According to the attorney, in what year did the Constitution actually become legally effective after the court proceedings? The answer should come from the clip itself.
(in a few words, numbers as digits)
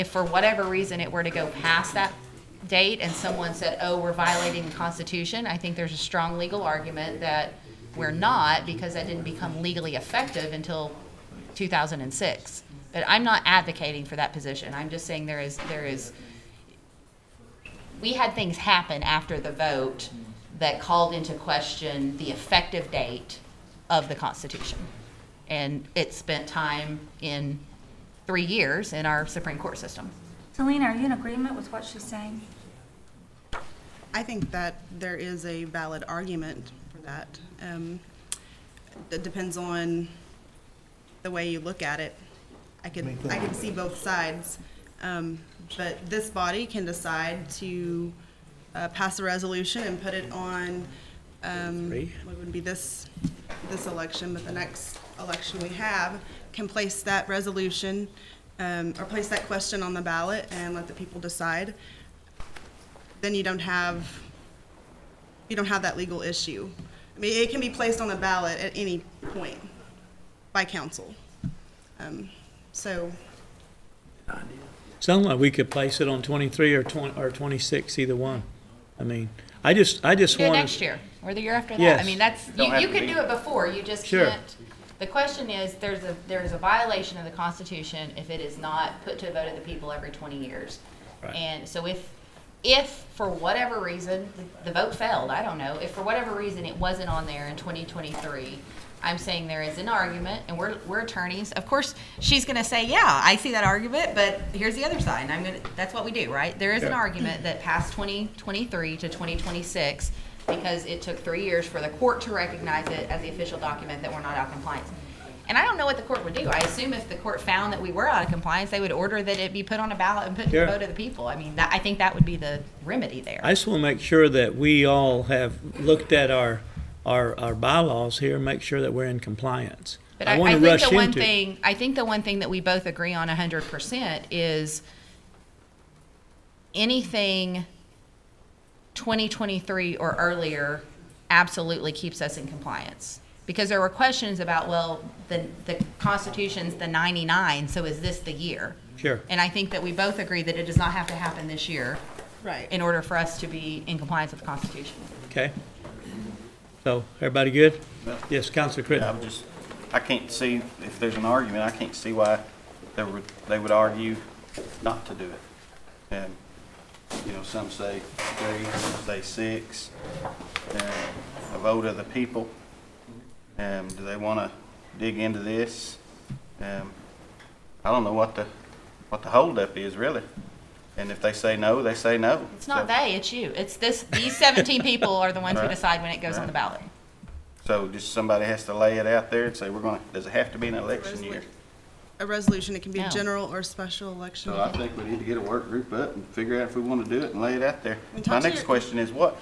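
2006.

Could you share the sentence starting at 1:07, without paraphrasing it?
I mean, it can be placed on the ballot at any point by council.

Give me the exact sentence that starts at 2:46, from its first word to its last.
And, you know, some say three, some say six, and a vote of the people.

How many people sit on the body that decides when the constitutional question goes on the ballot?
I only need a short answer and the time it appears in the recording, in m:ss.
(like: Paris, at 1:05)
17, at 3:04.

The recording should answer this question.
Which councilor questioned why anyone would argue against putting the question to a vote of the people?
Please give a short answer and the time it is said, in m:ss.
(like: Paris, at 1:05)
Councilor Crittenden, at 2:38.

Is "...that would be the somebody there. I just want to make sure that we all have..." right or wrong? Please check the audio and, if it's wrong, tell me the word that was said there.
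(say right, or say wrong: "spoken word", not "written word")
wrong: "remedy", not "somebody".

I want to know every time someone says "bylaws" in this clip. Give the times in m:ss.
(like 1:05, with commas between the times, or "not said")
2:07.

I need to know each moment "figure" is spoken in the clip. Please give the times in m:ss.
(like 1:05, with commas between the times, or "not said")
3:16.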